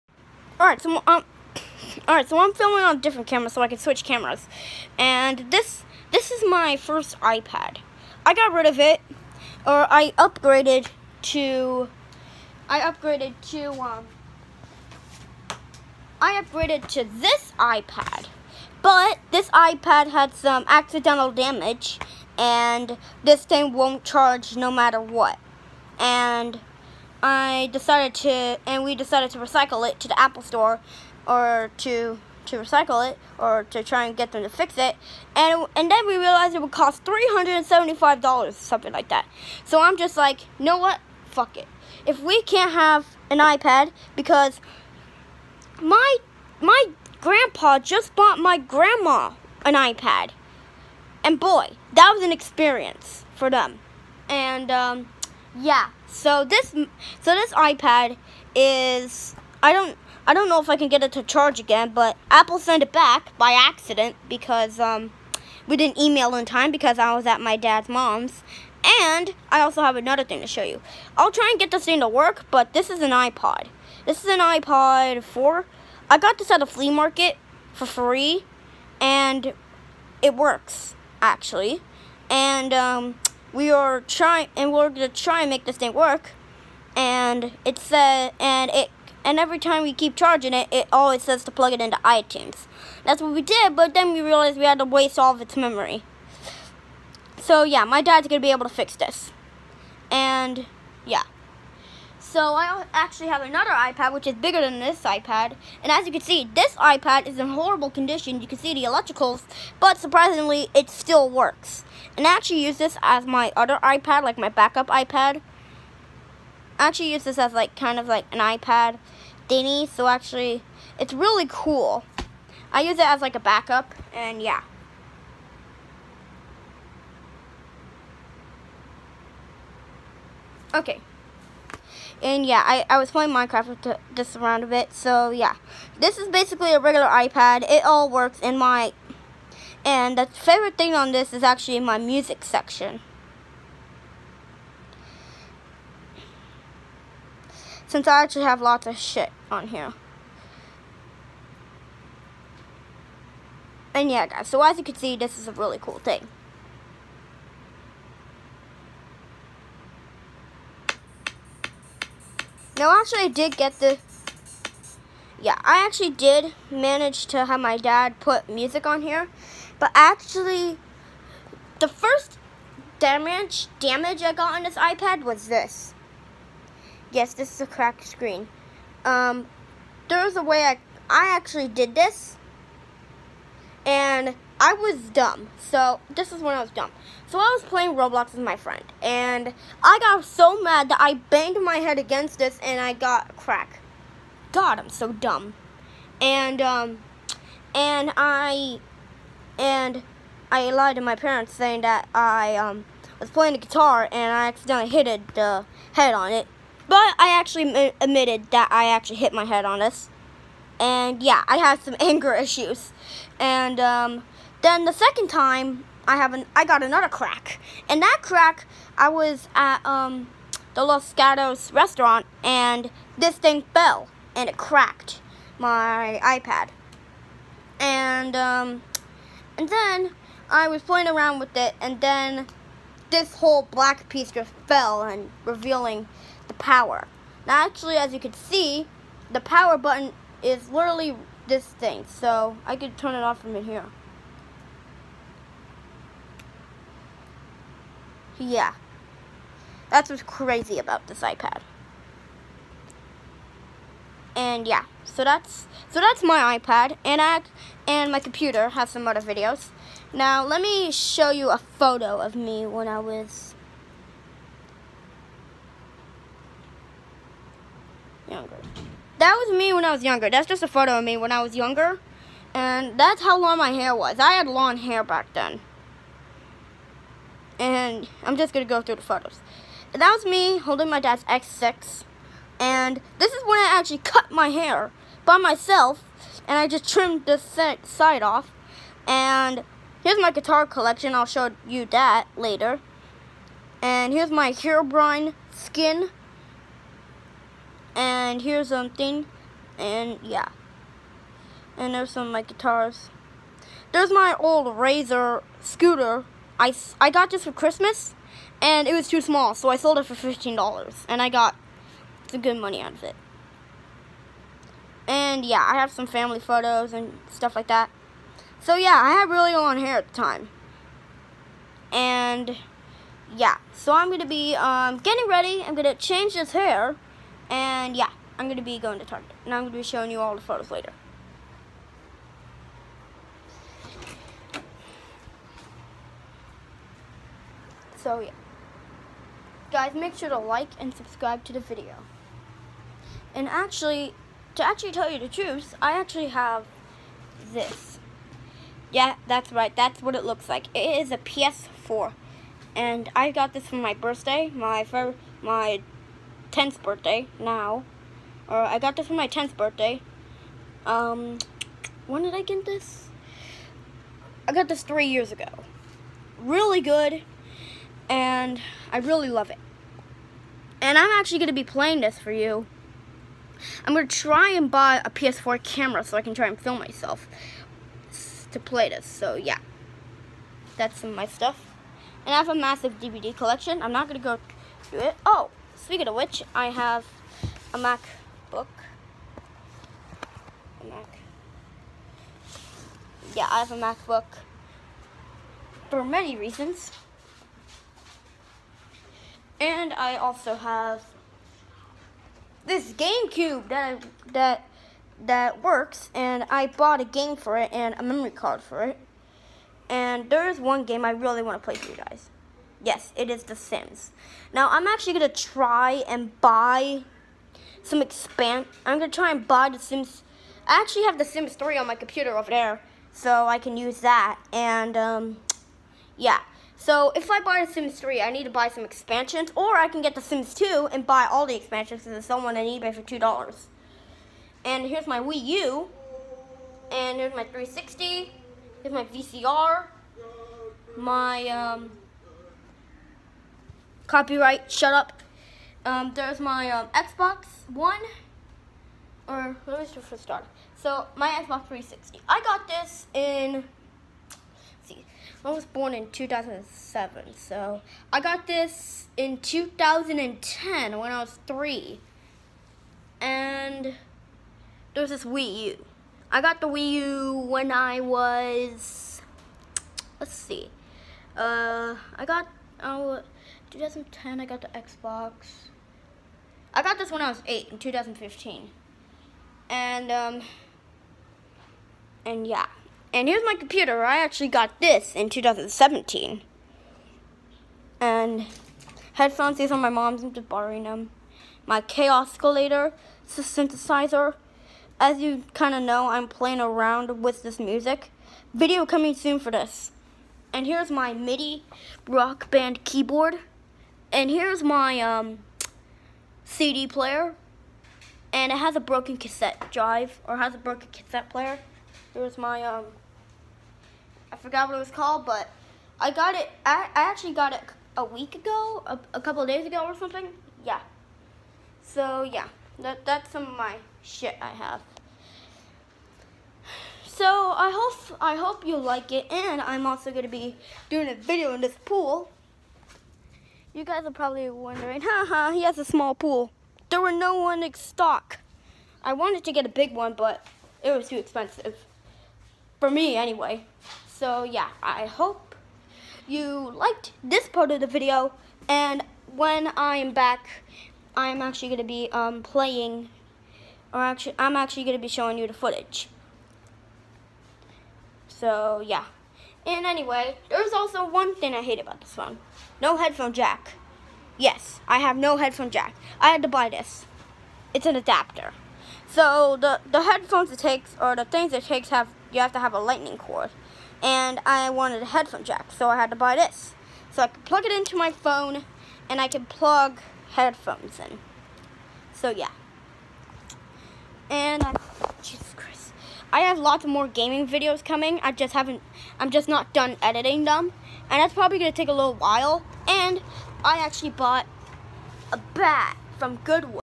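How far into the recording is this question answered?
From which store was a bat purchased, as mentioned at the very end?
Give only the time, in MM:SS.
09:56.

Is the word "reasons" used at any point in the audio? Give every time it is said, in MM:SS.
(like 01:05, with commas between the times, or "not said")
06:36.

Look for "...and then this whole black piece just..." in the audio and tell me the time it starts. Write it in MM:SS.
03:51.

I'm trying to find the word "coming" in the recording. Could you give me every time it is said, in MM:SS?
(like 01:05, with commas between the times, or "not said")
08:18, 09:47.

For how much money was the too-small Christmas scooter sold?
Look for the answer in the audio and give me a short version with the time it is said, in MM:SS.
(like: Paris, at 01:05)
$15, at 05:10.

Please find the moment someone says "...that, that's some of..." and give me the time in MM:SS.
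08:42.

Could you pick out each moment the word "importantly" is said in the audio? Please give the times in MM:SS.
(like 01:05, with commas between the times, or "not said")
not said.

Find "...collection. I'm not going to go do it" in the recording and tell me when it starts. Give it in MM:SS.
06:23.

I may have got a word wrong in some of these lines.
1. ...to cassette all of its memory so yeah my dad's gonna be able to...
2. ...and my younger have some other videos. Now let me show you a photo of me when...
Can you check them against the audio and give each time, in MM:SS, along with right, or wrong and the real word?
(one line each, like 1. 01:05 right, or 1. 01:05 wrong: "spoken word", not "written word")
1. 01:34 wrong: "waste", not "cassette"
2. 04:17 wrong: "computer", not "younger".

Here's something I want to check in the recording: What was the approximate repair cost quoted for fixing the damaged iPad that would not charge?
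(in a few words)
$375.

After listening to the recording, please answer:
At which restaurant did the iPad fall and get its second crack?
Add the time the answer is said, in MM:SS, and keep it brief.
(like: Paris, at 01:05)
Los Gatos restaurant, at 03:40.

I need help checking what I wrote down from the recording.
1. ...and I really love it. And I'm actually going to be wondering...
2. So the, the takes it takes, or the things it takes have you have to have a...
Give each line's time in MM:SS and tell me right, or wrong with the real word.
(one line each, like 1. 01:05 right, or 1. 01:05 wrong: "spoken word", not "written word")
1. 06:08 wrong: "playing", not "wondering"
2. 09:29 wrong: "headphones", not "takes".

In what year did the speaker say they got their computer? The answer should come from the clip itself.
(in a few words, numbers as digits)
2017.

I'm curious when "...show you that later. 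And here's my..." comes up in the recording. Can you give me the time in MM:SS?
04:51.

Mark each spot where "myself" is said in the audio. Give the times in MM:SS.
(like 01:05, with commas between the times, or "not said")
04:45, 06:16.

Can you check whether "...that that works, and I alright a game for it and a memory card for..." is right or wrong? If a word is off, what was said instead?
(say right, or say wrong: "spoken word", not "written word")
wrong: "bought", not "alright".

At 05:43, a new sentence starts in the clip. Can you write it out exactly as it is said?
And actually, to actually tell you the truth, I actually have this.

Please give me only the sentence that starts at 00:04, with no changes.
And this this is my first iPad.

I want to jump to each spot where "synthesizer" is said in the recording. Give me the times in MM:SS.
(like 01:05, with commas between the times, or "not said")
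08:13.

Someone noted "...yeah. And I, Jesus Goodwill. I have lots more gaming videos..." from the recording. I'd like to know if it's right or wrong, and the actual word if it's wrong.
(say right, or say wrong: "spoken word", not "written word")
wrong: "Christ", not "Goodwill".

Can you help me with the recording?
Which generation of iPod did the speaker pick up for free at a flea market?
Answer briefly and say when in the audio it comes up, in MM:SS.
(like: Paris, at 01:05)
iPod 4, at 01:14.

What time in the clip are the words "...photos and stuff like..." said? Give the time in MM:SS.
05:16.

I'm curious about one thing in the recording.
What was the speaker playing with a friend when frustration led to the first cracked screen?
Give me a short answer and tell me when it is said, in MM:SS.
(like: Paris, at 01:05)
Roblox, at 03:07.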